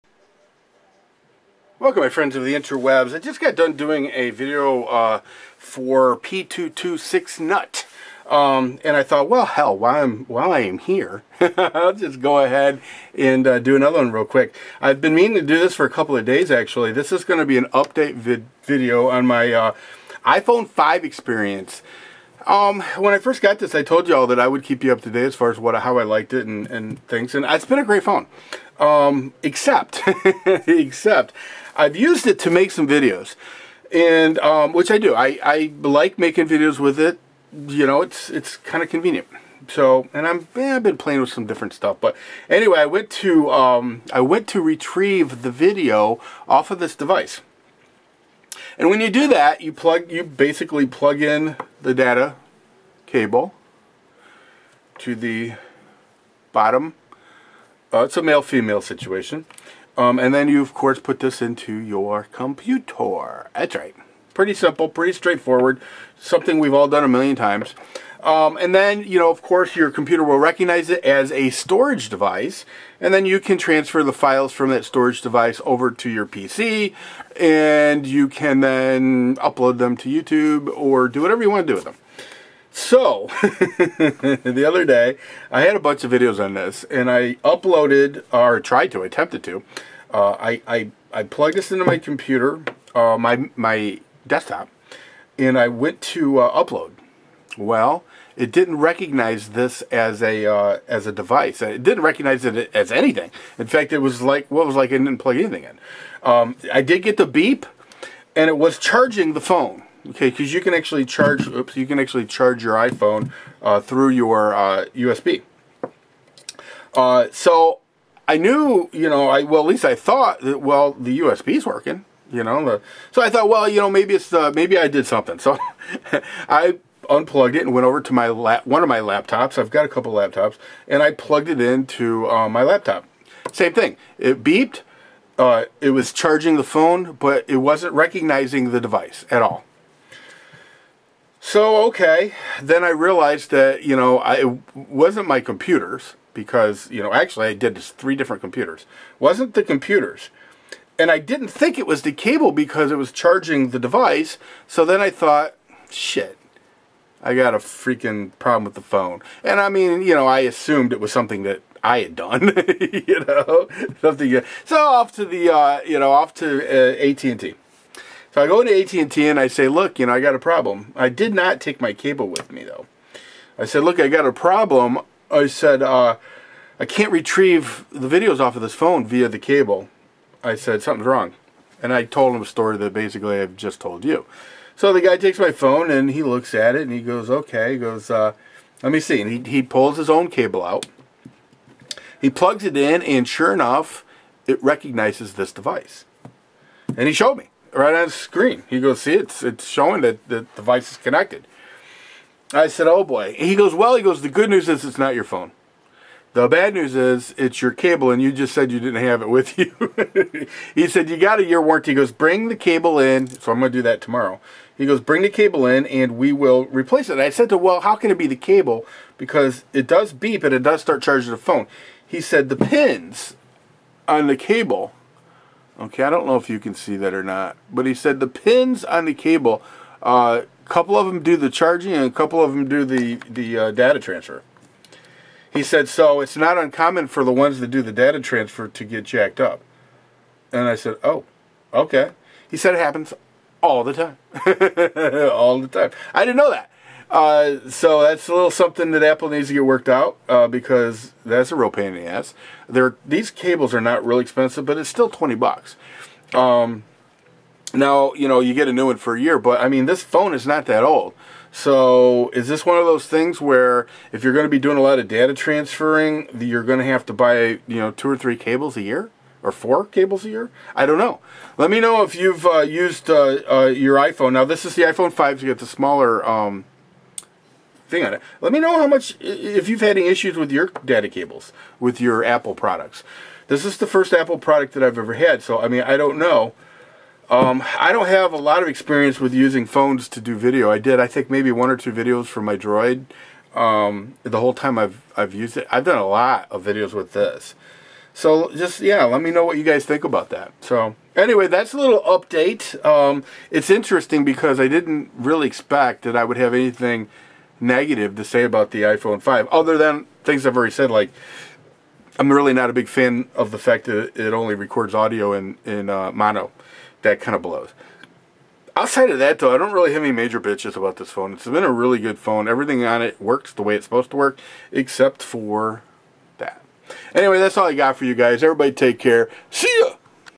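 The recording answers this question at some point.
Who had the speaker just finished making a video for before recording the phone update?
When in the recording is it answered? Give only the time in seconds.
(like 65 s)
6 s.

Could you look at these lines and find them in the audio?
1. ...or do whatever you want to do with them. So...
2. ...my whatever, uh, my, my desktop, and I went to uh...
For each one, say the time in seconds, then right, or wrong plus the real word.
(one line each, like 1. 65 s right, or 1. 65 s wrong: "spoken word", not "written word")
1. 80 s right
2. 91 s wrong: "computer", not "whatever".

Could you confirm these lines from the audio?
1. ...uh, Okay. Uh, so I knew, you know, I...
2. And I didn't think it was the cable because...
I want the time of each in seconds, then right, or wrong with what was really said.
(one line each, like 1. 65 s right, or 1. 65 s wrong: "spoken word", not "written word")
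1. 114 s wrong: "USB", not "Okay"
2. 150 s right.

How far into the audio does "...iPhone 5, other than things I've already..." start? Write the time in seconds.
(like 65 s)
308 s.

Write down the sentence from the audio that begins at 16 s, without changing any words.
This is going to be an update vid video on my uh, iPhone 5 experience.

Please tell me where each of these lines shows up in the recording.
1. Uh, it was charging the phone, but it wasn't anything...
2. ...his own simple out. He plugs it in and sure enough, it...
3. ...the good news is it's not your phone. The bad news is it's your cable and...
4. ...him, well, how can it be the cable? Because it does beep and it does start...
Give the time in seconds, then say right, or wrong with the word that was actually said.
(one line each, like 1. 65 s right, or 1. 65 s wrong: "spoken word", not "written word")
1. 135 s wrong: "recognizing", not "anything"
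2. 189 s wrong: "cable", not "simple"
3. 204 s right
4. 217 s right.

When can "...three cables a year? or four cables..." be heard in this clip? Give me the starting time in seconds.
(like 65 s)
268 s.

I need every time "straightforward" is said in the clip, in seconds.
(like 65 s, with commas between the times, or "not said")
65 s.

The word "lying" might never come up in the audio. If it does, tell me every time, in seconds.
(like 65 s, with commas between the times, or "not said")
not said.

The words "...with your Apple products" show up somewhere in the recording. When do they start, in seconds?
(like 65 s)
281 s.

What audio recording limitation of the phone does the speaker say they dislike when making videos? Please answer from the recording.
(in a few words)
mono.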